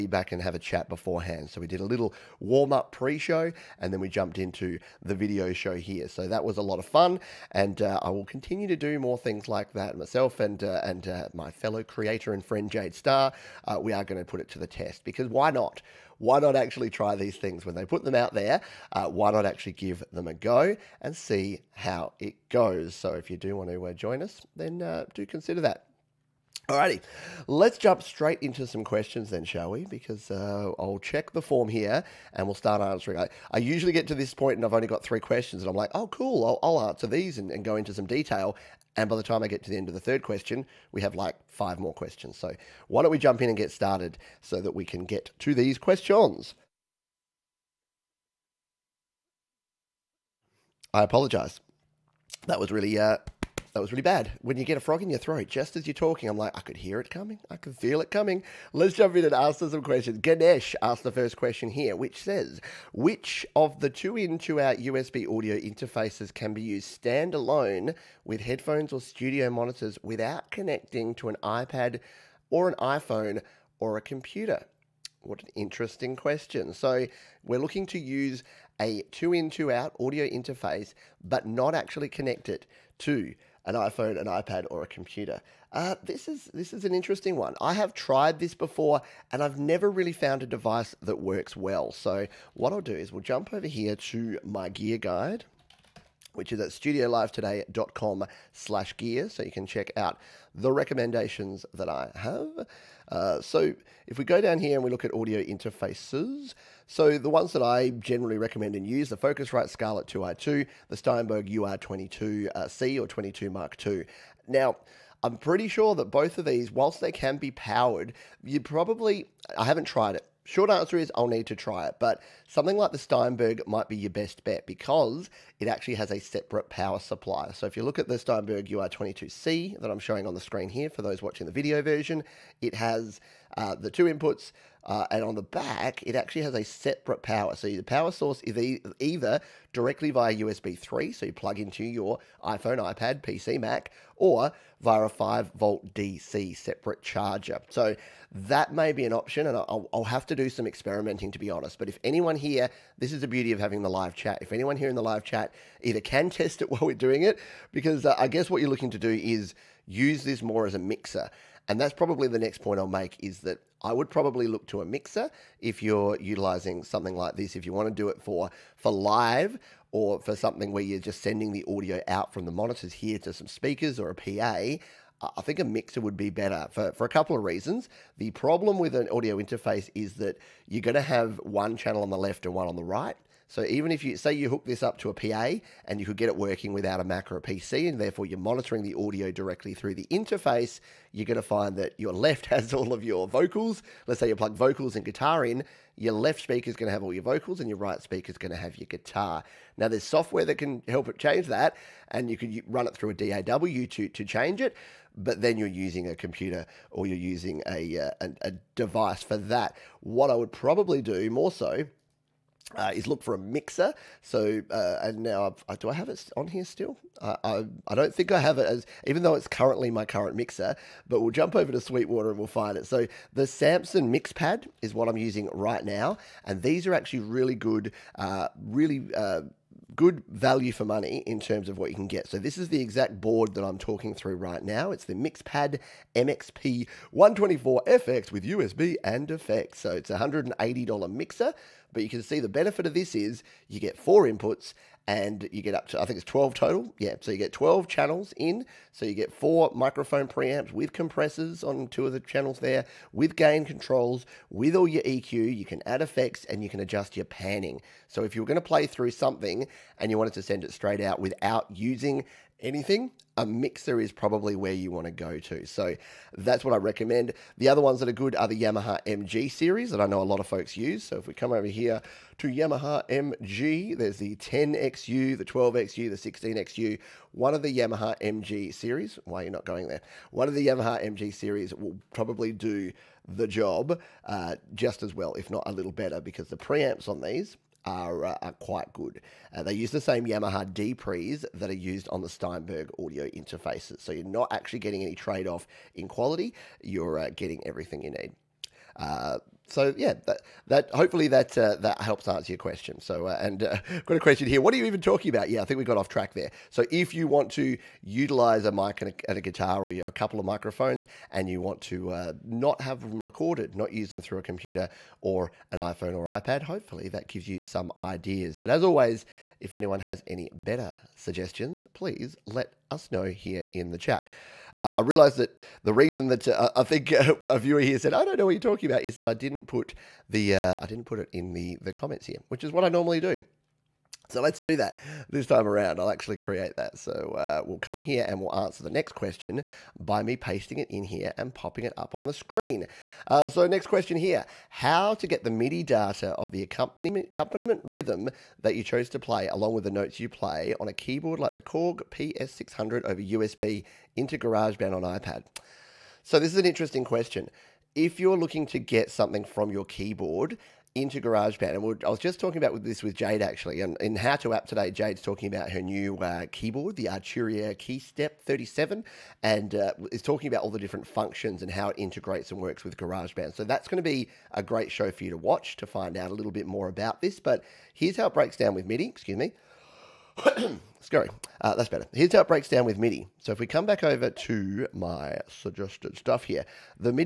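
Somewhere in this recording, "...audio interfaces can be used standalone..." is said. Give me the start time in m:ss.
1:05.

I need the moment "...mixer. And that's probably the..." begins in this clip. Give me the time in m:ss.
2:40.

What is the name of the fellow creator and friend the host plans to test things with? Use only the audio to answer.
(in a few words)
Jade Star.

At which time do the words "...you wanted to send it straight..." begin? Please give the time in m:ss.
4:20.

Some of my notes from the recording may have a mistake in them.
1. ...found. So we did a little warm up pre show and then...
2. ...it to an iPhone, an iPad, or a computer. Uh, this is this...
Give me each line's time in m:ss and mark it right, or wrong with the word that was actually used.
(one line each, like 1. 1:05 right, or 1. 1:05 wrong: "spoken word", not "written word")
1. 0:00 wrong: "beforehand", not "found"
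2. 1:22 right.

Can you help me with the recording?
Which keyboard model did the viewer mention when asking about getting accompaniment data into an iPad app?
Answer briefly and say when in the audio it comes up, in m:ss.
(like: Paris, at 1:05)
Korg PA600, at 5:51.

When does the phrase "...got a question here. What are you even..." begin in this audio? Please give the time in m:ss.
5:04.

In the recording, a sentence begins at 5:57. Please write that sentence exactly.
If you're looking to get something from your keyboard, into GarageBand.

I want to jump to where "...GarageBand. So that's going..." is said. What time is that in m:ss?
6:12.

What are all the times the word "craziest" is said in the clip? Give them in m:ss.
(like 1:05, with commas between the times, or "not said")
not said.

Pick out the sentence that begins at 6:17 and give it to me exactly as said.
But here's how it breaks down with MIDI.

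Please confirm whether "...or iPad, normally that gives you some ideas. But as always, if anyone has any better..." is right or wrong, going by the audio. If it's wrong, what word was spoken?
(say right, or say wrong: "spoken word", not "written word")
wrong: "hopefully", not "normally".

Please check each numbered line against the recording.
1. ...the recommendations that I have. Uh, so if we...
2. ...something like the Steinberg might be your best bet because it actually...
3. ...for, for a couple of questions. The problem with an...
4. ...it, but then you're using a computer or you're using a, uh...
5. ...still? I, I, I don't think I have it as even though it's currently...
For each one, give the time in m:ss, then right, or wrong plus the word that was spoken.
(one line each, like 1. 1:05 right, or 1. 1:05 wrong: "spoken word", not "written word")
1. 1:40 right
2. 2:02 right
3. 2:56 wrong: "reasons", not "questions"
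4. 3:24 right
5. 3:36 right.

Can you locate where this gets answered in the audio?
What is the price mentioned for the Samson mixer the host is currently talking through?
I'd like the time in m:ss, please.
4:00.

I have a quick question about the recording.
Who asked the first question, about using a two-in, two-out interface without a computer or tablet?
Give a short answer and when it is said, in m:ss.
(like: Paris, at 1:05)
Ganesh, at 1:00.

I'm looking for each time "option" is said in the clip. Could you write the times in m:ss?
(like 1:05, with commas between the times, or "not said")
2:29.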